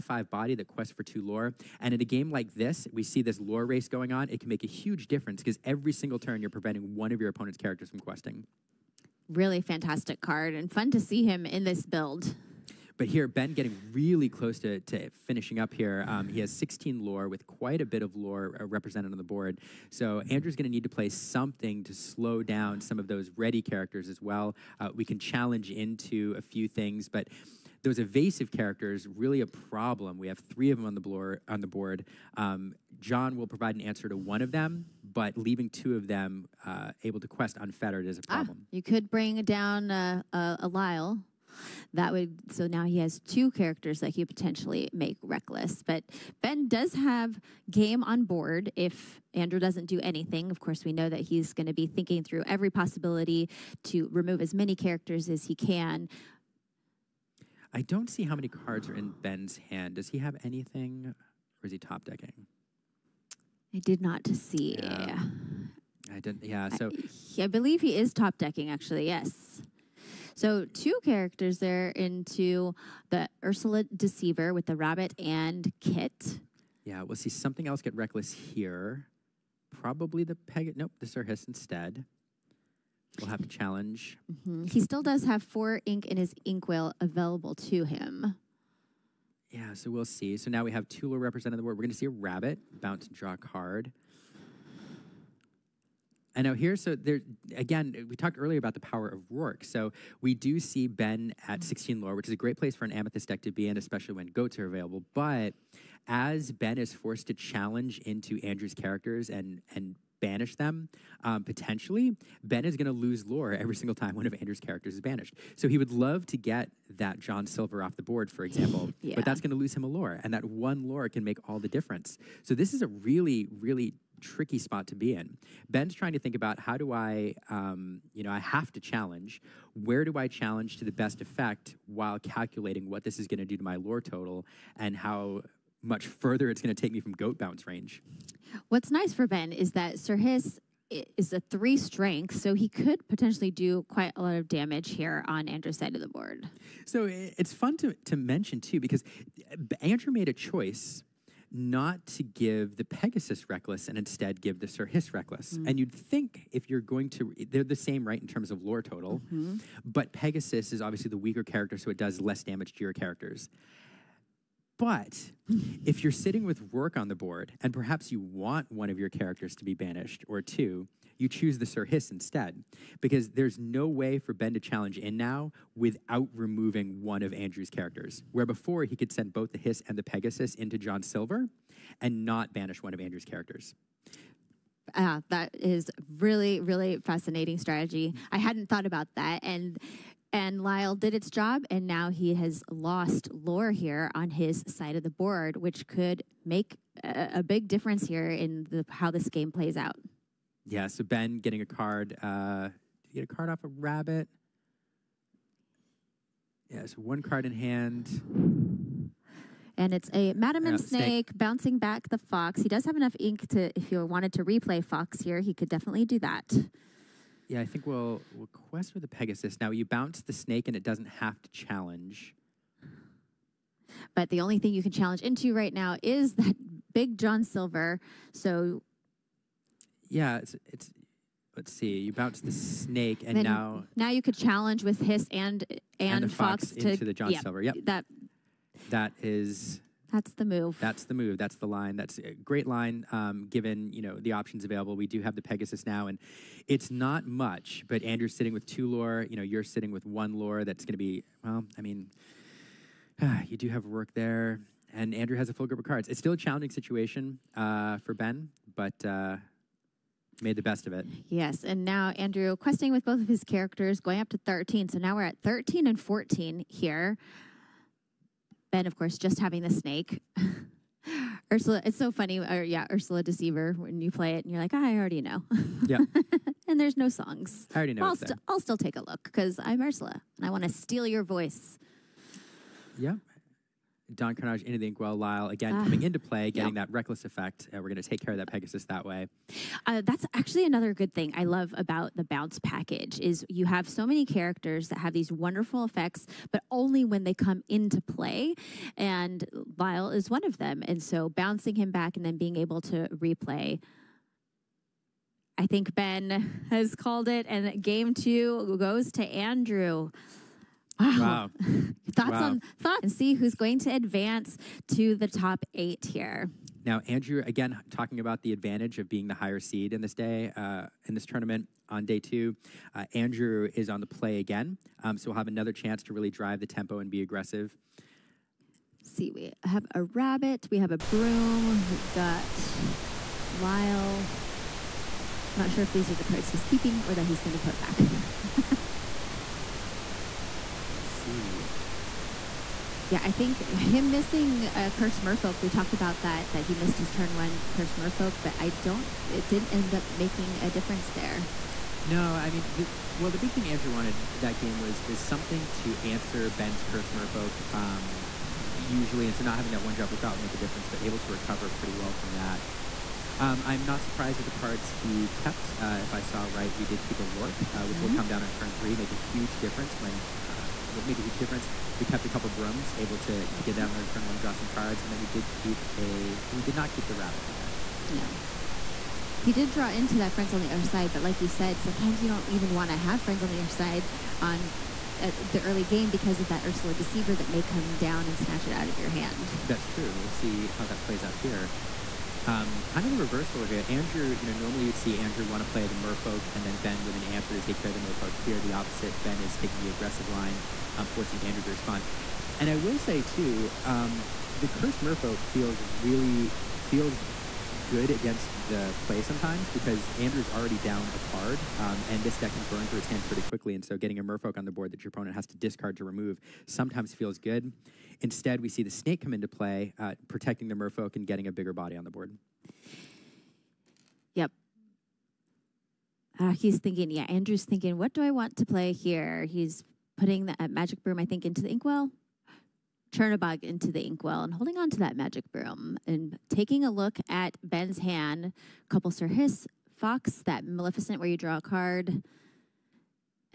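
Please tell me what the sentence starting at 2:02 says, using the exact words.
So this is a really, really tricky spot to be in.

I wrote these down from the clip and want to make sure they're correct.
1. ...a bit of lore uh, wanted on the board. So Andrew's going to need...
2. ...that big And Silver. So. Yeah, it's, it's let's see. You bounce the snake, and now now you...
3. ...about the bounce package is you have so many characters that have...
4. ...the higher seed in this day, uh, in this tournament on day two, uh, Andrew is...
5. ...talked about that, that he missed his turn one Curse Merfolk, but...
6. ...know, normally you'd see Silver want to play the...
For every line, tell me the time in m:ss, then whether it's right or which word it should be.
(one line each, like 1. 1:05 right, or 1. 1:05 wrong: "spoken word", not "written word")
1. 0:17 wrong: "represented", not "wanted"
2. 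3:46 wrong: "John", not "And"
3. 4:51 right
4. 5:19 right
5. 5:45 right
6. 6:34 wrong: "Andrew", not "Silver".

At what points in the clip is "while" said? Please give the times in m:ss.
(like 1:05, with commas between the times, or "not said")
2:11.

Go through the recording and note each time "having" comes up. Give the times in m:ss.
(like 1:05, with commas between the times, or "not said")
4:29, 5:59.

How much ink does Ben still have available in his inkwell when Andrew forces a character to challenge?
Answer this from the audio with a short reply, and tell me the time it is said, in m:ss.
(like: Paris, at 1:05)
4, at 1:25.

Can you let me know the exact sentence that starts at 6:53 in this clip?
And so, getting a Merfolk on the board that your opponent has to discard to remove sometimes feels good.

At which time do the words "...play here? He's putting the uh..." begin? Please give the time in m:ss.
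7:08.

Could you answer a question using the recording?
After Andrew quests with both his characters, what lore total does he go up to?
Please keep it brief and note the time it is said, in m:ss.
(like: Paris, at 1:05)
13, at 4:24.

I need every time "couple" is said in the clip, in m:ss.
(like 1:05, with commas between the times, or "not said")
6:12, 7:18.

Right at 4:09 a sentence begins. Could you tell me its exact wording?
You know, you're sitting with one lore.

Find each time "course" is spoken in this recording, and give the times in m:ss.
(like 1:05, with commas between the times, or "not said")
0:50, 4:28.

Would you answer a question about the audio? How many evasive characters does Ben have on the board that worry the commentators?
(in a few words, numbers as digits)
3.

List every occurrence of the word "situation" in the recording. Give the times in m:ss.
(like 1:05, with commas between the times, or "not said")
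4:16.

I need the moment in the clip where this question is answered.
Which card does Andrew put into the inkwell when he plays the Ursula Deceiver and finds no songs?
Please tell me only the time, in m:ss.
4:44.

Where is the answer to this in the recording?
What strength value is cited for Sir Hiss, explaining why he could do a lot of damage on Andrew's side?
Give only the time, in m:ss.
2:21.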